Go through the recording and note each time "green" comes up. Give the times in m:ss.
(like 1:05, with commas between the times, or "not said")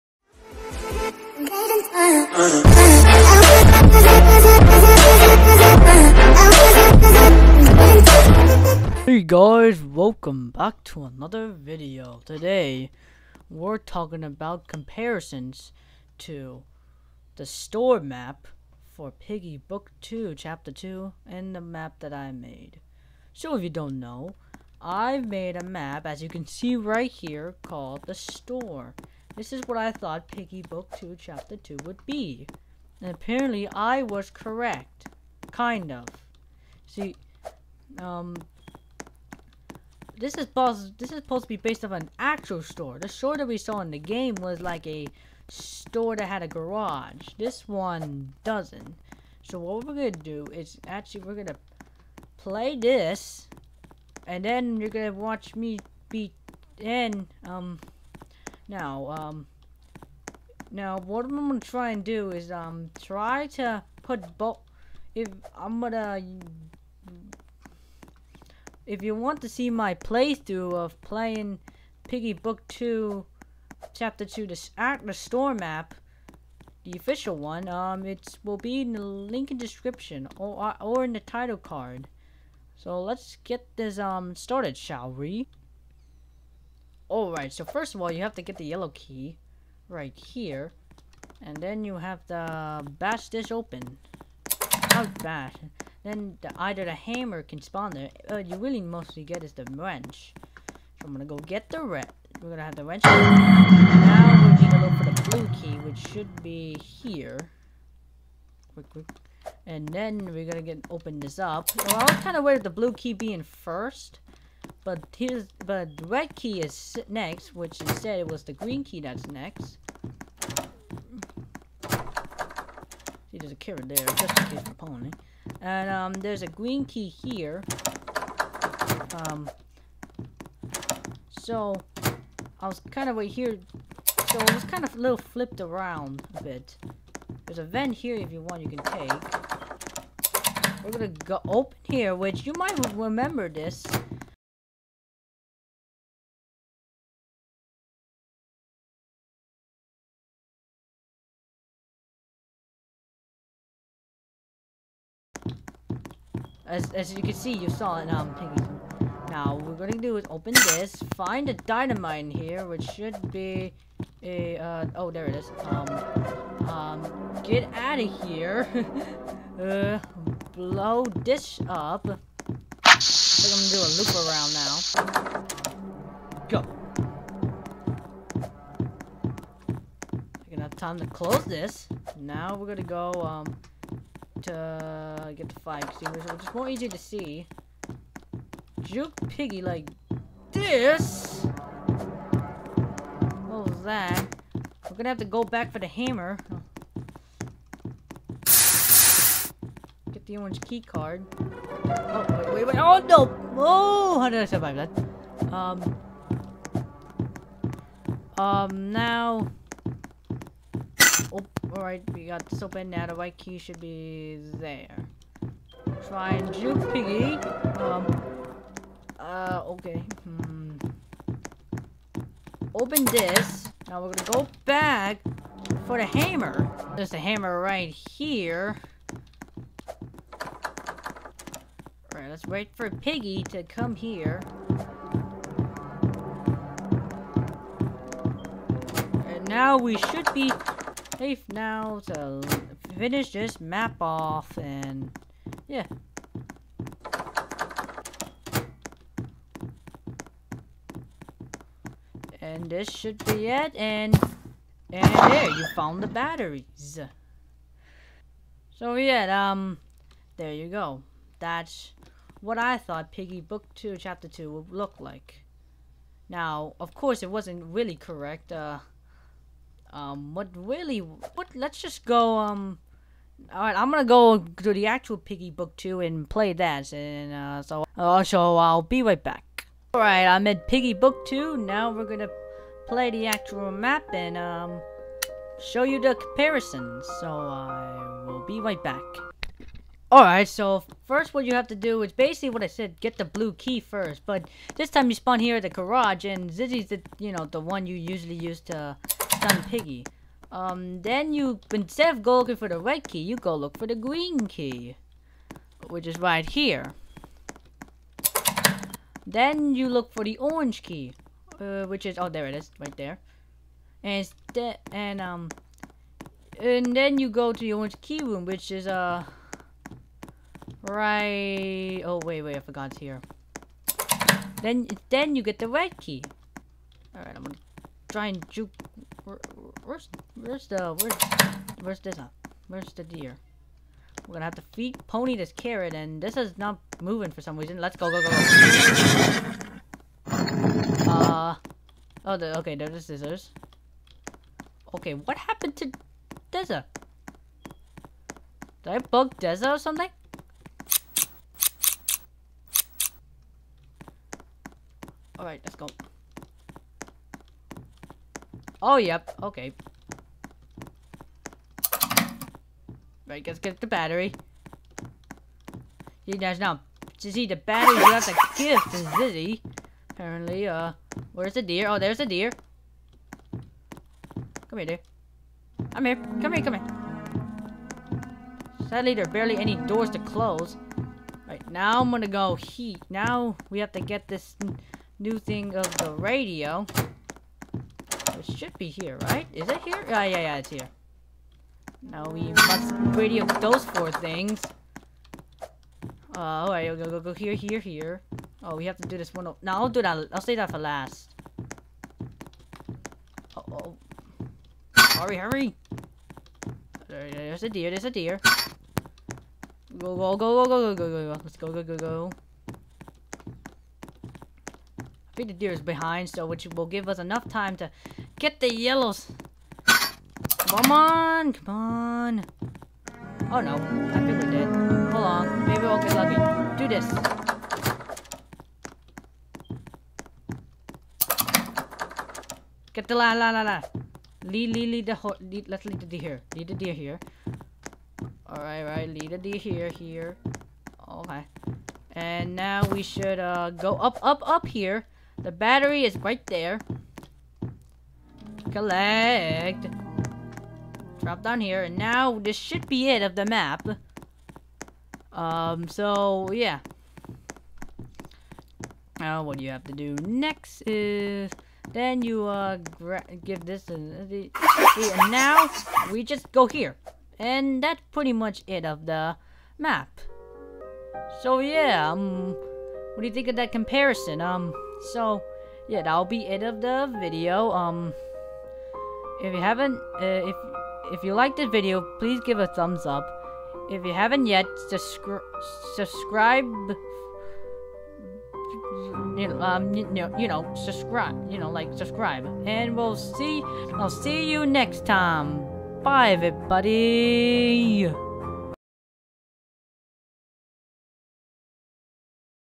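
1:58, 2:06, 5:03.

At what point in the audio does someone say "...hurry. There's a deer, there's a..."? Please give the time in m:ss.
6:45.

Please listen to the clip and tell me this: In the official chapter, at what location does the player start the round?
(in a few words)
The garage.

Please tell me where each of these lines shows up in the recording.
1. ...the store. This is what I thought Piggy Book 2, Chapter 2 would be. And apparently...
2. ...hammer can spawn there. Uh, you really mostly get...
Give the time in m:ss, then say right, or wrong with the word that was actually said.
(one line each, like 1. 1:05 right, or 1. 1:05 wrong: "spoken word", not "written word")
1. 0:28 right
2. 1:36 right.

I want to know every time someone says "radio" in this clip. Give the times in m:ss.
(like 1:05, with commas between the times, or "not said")
6:26, 6:33.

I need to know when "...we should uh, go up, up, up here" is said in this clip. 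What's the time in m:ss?
7:22.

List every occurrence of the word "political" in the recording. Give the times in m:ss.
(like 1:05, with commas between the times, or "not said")
not said.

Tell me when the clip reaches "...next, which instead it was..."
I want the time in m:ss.
1:57.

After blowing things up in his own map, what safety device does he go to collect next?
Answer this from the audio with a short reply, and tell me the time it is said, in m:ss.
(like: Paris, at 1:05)
Fire extinguisher, at 3:05.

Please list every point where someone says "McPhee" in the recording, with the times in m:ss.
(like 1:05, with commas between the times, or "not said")
not said.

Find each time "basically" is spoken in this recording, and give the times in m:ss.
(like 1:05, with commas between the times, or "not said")
4:52.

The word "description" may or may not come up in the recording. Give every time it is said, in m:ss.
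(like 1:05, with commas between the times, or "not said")
1:19.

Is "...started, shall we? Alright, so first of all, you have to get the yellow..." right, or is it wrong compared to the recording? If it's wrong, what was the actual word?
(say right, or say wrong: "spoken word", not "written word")
right.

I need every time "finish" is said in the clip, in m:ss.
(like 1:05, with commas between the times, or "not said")
4:02.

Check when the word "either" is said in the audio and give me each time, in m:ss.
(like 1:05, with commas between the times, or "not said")
1:36.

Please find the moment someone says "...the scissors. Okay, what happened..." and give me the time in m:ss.
5:42.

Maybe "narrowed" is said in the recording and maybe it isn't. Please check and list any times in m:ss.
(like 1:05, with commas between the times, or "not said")
not said.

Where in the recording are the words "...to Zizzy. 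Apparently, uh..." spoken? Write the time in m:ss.
6:08.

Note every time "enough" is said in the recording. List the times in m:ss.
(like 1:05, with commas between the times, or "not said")
6:57.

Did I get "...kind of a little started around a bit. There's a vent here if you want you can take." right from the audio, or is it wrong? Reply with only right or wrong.
wrong.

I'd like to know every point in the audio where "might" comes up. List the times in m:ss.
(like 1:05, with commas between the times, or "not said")
2:22.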